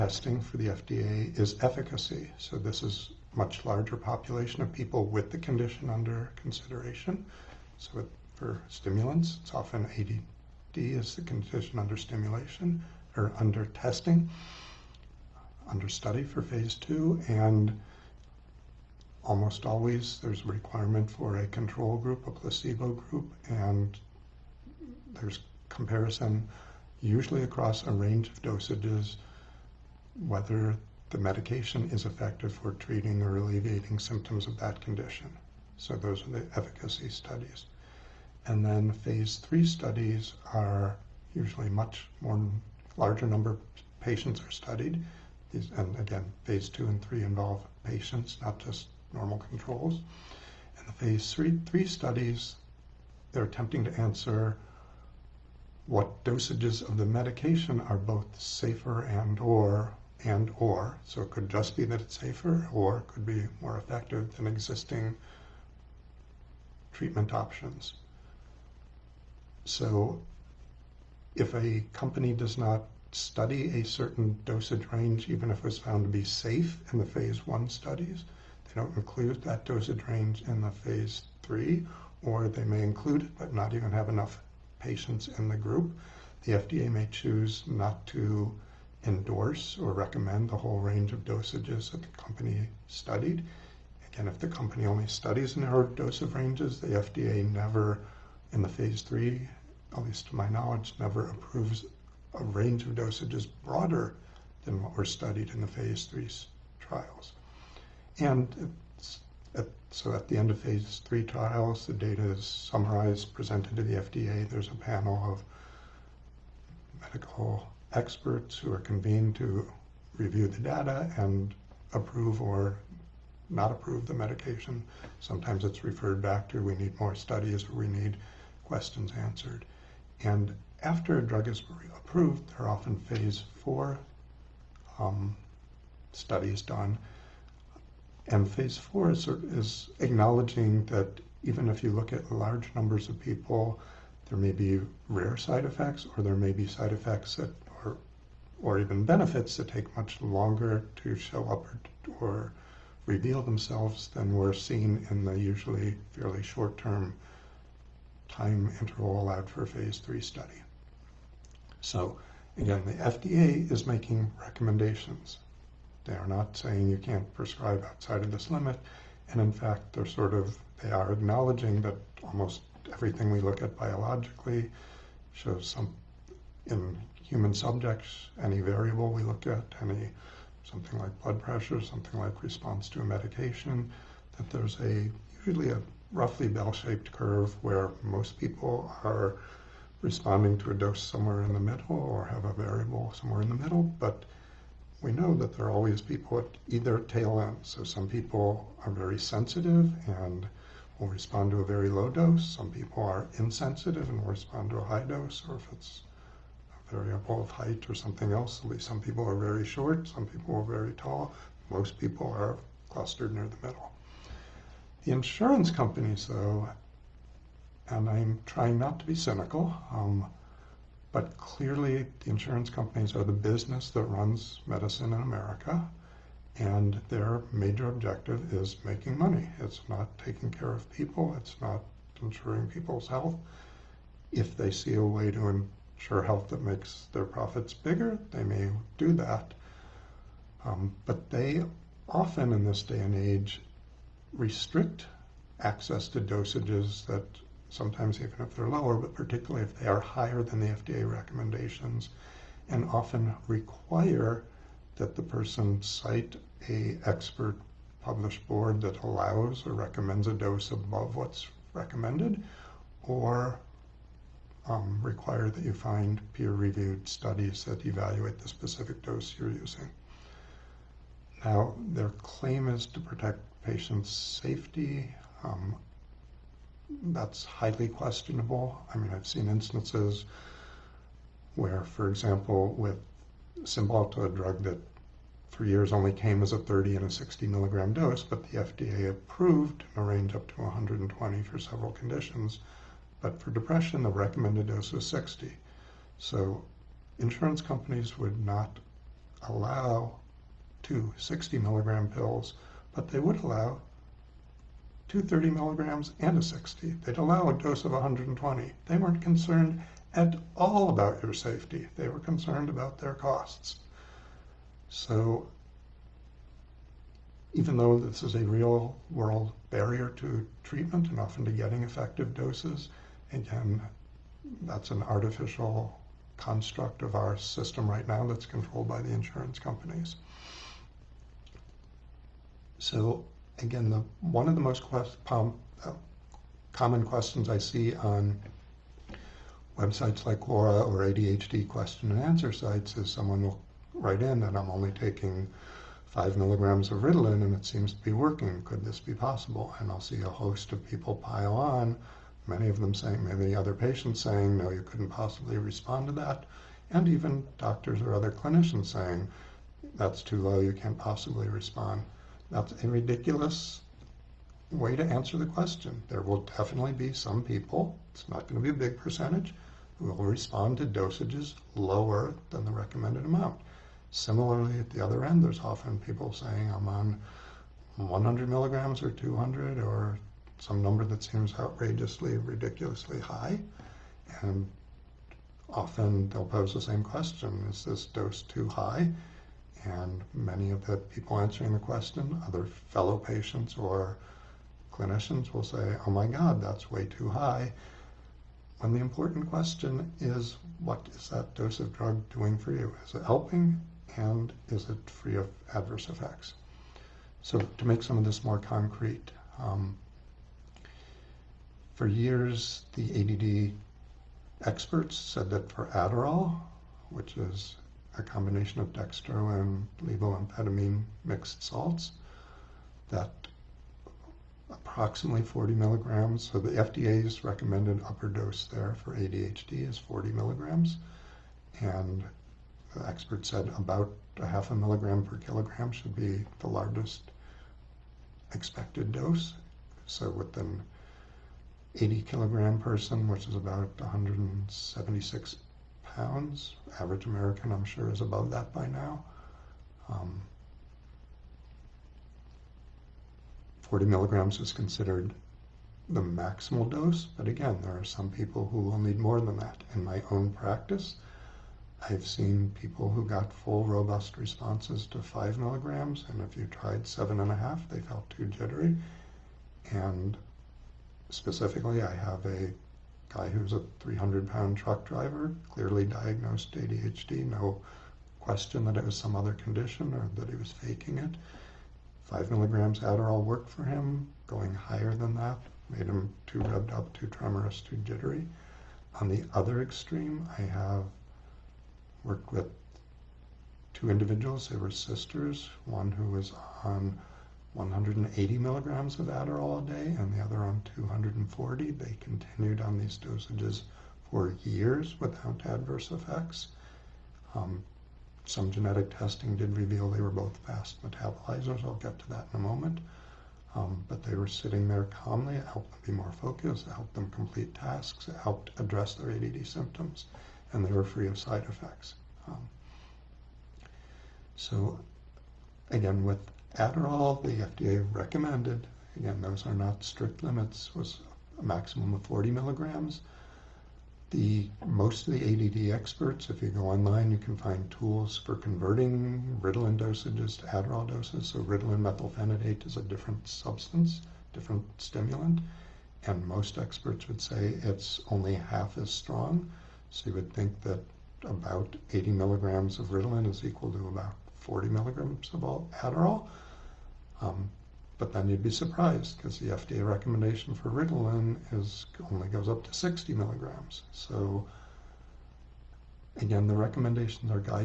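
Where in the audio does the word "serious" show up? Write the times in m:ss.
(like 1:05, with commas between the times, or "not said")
not said.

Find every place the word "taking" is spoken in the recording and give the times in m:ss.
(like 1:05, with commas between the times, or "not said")
3:50, 5:44.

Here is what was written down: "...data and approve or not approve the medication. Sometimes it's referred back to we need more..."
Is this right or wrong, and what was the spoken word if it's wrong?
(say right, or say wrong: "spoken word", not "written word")
right.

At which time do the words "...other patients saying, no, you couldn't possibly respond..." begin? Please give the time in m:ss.
5:53.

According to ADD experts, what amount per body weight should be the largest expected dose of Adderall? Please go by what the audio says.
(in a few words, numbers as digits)
half a milligram per kilogram.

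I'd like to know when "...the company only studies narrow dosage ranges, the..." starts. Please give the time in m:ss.
1:34.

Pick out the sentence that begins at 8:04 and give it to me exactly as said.
Going higher than that made him too rubbed up, too tremorous, too jittery.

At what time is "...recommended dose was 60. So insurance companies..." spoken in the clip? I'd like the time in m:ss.
4:54.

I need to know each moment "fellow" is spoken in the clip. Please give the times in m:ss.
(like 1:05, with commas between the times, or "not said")
6:32.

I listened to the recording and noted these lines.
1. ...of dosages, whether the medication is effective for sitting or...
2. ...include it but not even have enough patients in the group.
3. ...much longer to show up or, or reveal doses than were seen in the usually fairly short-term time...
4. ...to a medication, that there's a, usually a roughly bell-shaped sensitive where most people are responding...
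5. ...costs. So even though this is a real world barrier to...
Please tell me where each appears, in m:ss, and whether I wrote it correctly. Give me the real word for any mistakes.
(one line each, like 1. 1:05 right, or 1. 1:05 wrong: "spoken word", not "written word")
1. 0:28 wrong: "treating", not "sitting"
2. 1:22 right
3. 2:29 wrong: "themselves", not "doses"
4. 3:02 wrong: "curve", not "sensitive"
5. 5:13 right.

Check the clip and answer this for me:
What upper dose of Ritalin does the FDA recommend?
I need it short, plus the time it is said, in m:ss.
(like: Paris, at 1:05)
60 milligrams, at 9:22.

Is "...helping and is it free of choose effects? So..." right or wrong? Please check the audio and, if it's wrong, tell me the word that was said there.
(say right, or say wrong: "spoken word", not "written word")
wrong: "adverse", not "choose".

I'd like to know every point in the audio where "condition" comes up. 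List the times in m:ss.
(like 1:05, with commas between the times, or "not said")
0:05, 0:11, 0:34, 4:51, 7:59.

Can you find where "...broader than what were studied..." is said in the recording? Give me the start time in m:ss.
1:43.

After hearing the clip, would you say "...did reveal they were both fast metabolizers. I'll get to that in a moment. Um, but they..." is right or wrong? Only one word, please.
right.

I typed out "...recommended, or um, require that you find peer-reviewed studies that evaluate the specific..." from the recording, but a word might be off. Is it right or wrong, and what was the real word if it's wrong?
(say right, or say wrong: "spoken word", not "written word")
right.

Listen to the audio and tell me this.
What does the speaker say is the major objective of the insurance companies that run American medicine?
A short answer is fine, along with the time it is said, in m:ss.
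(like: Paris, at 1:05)
making money, at 3:48.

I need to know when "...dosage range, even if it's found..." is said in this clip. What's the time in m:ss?
1:14.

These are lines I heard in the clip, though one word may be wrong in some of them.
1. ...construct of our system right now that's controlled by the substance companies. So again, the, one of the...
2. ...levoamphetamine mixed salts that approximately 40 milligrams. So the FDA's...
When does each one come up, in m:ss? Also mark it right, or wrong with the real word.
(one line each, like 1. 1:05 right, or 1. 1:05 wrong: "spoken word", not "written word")
1. 5:26 wrong: "insurance", not "substance"
2. 7:00 right.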